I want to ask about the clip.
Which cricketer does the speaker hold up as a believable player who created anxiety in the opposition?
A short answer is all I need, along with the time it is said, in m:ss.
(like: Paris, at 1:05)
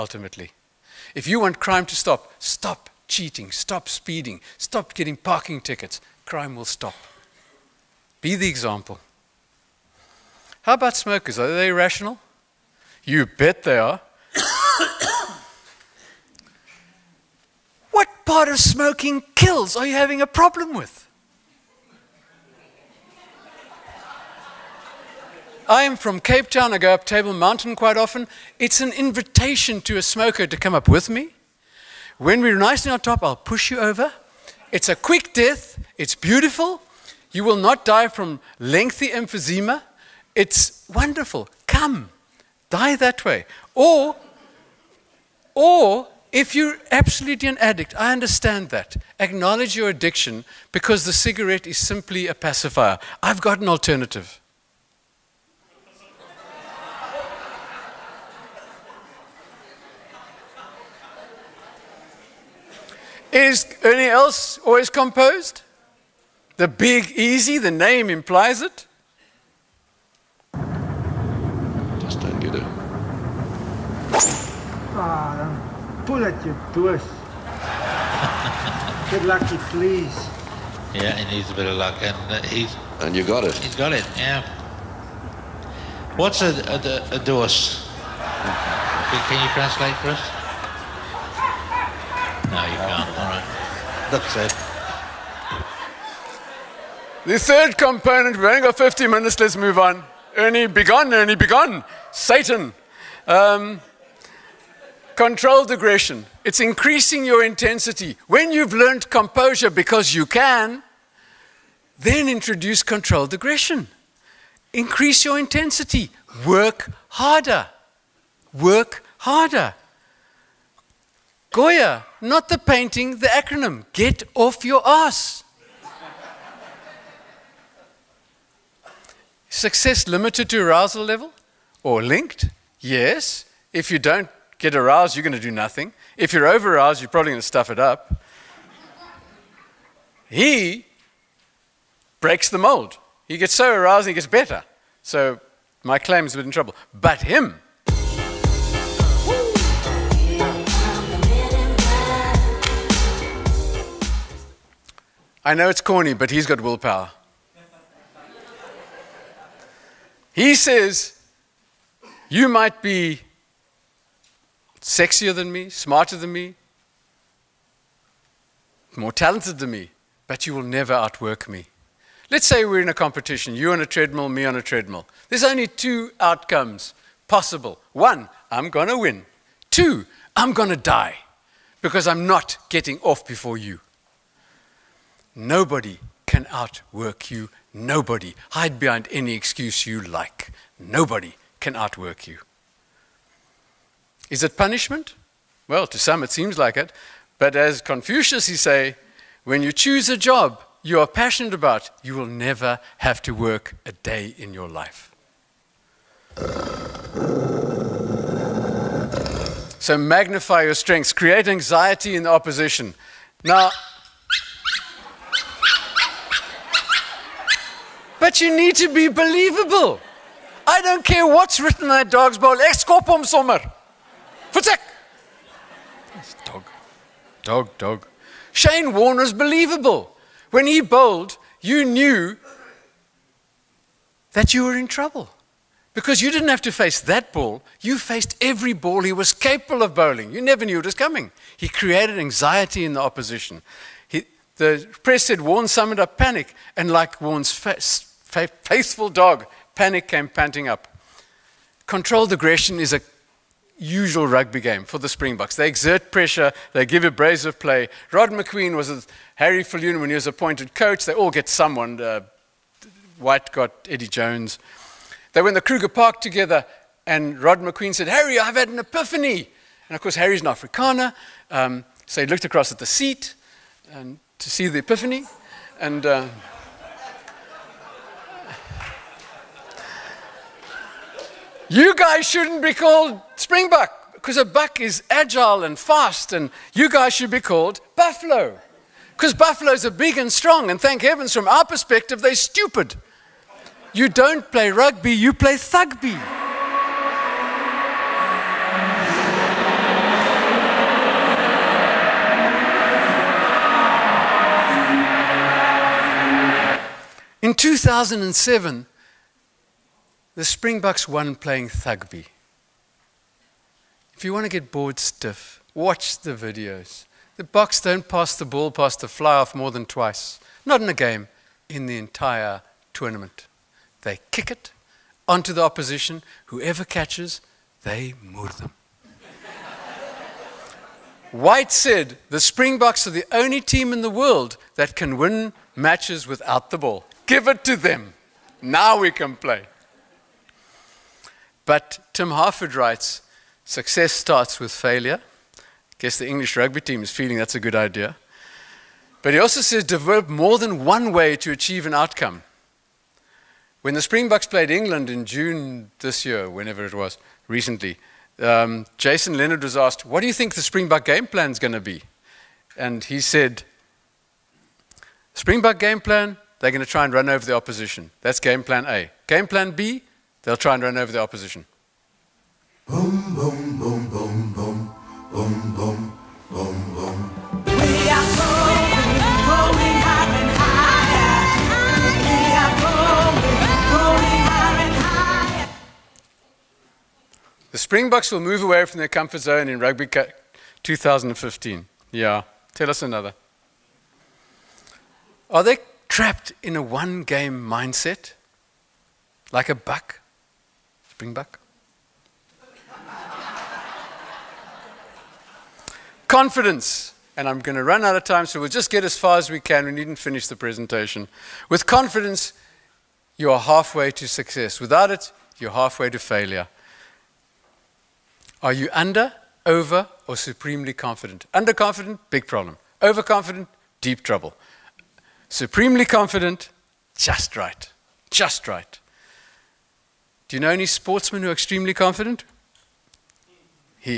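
Shane Warne, at 3:48.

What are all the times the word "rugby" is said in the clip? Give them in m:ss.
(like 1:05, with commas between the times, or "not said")
4:14, 4:54, 5:46, 6:29.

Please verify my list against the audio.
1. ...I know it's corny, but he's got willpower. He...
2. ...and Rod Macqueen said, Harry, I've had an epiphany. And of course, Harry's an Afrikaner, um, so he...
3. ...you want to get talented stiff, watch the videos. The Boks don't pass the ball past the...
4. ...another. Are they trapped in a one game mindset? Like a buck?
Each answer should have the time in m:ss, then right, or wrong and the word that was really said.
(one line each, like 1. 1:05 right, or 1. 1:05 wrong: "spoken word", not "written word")
1. 2:35 right
2. 4:27 right
3. 5:14 wrong: "bored", not "talented"
4. 6:33 right.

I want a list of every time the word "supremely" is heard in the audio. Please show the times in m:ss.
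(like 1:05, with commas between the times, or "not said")
7:00, 7:05.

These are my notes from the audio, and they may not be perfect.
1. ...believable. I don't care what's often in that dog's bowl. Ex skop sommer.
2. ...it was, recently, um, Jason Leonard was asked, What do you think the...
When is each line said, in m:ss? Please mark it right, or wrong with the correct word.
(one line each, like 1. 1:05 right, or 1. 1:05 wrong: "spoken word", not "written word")
1. 3:39 wrong: "written", not "often"
2. 5:56 right.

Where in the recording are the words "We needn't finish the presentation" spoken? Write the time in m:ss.
6:49.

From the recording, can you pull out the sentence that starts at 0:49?
Acknowledge your addiction because the cigarette is simply a pacifier.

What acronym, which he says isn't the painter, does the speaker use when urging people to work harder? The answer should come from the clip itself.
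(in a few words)
Goya.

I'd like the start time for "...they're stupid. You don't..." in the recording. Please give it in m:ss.
4:52.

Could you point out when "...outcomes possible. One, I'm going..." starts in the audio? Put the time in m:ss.
2:56.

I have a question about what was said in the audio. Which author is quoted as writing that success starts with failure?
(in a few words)
Tim Harford.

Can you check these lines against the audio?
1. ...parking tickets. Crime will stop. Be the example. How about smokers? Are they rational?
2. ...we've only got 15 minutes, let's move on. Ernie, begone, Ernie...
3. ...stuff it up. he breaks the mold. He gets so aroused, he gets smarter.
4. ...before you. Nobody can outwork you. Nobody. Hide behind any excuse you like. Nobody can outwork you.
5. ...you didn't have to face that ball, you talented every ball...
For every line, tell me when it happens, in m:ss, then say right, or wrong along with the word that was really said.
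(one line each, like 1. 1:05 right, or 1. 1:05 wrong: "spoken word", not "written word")
1. 0:05 right
2. 1:38 right
3. 2:17 wrong: "better", not "smarter"
4. 3:03 right
5. 3:56 wrong: "faced", not "talented".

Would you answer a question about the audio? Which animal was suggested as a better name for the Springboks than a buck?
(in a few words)
buffalo.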